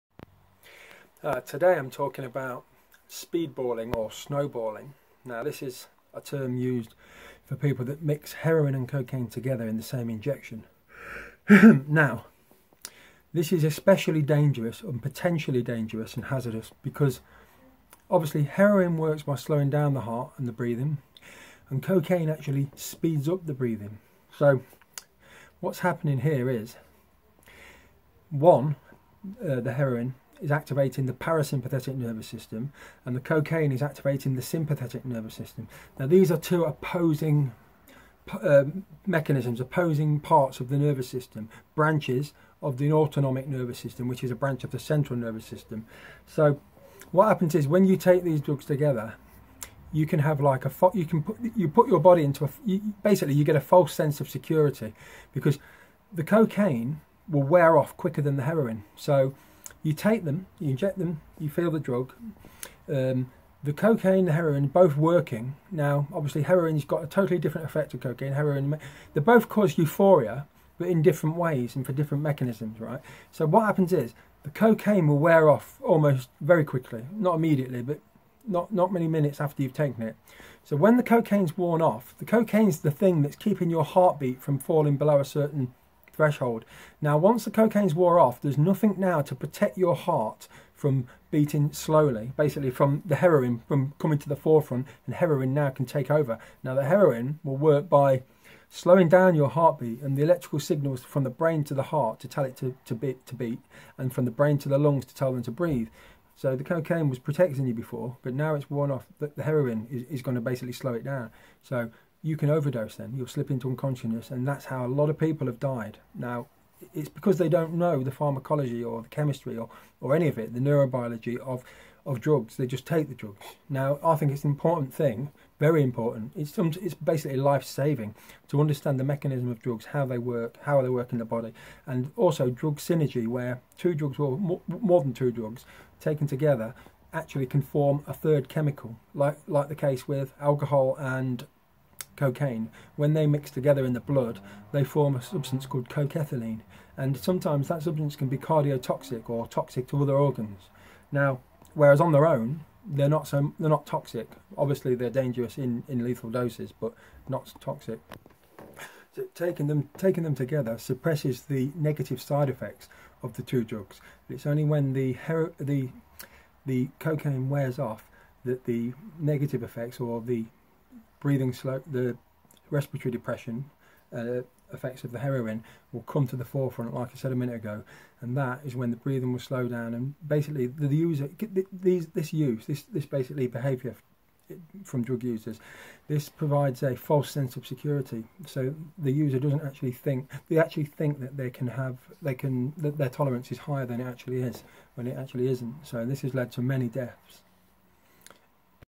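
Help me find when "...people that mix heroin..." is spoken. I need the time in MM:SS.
00:07.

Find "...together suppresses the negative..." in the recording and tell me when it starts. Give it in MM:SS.
02:40.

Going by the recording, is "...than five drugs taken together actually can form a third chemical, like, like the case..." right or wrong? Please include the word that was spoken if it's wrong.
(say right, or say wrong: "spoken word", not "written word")
wrong: "two", not "five".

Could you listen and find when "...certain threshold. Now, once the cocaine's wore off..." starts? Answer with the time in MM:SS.
01:25.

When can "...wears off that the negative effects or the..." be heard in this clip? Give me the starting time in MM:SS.
02:47.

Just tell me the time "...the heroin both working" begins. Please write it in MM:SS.
01:04.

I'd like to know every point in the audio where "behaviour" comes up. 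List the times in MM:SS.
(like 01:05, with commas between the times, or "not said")
03:03.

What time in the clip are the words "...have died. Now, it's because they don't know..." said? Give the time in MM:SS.
01:55.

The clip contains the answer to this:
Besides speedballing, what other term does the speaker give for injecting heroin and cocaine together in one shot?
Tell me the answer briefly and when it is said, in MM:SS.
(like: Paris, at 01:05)
snowballing, at 00:04.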